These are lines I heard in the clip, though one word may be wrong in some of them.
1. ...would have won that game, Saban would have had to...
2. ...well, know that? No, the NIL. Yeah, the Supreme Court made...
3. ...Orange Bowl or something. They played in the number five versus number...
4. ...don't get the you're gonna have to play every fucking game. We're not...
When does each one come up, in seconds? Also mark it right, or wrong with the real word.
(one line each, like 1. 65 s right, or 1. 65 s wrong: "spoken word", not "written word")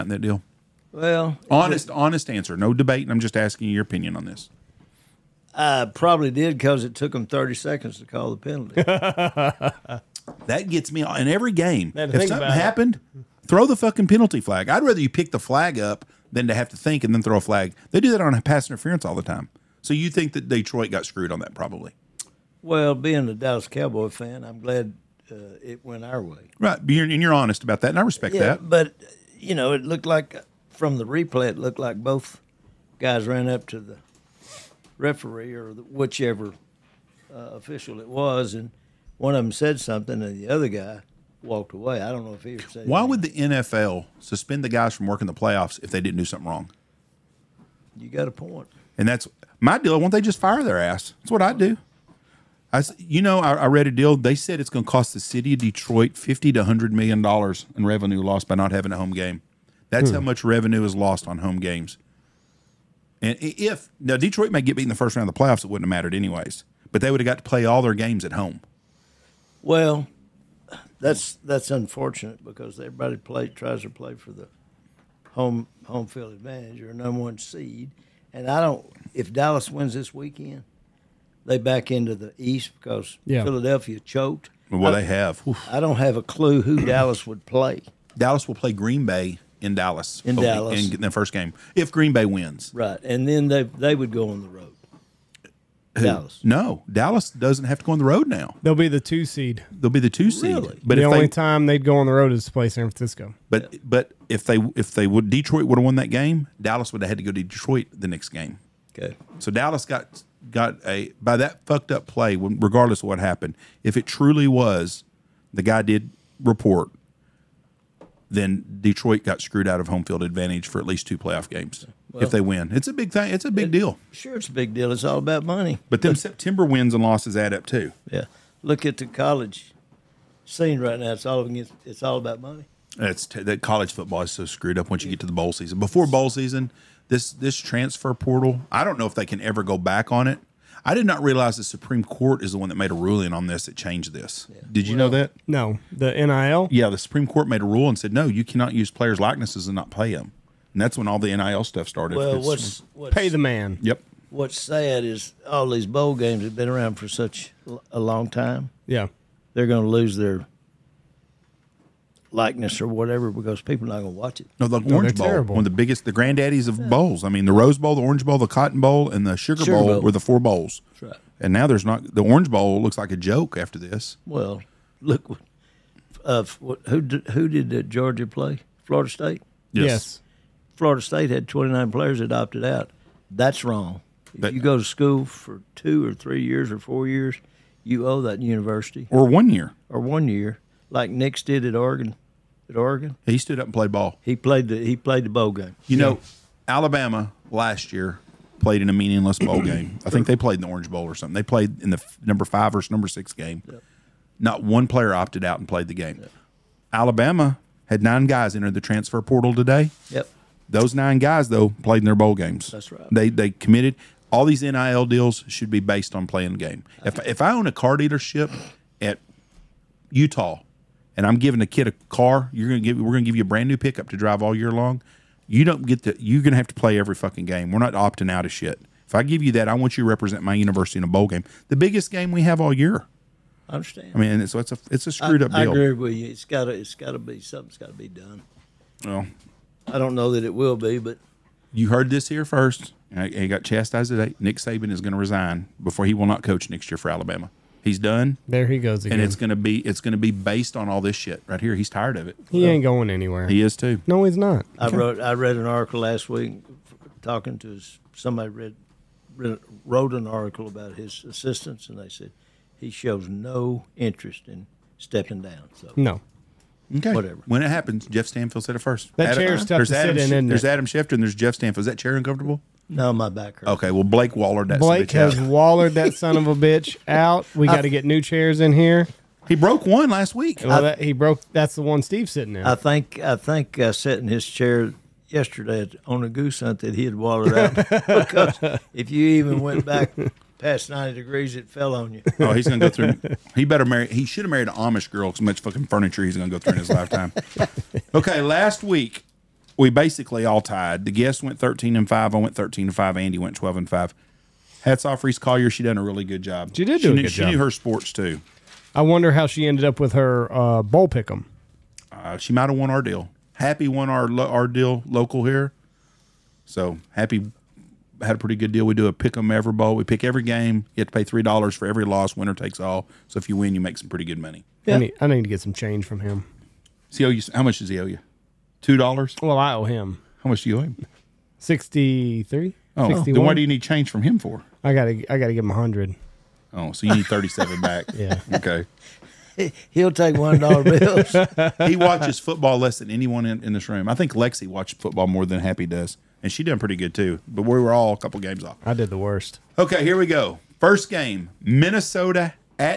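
1. 105 s wrong: "Dallas", not "Saban"
2. 144 s right
3. 200 s right
4. 225 s right.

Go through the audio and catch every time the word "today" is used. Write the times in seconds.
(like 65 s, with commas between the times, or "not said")
209 s, 244 s.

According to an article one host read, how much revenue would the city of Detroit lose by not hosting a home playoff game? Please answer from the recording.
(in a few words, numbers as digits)
50 to 100 million dollars.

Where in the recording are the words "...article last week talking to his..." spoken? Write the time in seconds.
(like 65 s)
255 s.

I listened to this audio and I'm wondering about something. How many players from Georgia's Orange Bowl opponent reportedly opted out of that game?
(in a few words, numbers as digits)
29.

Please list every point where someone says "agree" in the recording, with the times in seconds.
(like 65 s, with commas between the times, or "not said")
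235 s.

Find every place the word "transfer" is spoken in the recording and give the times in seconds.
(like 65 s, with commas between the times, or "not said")
137 s, 208 s.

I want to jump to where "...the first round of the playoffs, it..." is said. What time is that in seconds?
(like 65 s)
64 s.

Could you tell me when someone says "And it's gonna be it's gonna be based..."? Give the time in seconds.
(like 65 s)
249 s.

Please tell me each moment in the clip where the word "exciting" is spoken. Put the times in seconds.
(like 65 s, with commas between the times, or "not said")
not said.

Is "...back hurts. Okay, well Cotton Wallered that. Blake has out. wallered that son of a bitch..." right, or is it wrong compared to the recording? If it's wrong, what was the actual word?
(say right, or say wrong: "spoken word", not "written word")
wrong: "Blake", not "Cotton".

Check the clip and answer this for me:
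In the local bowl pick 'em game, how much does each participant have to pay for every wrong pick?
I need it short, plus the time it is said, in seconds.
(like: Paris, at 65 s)
3 dollars, at 321 s.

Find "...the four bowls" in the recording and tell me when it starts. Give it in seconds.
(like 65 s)
170 s.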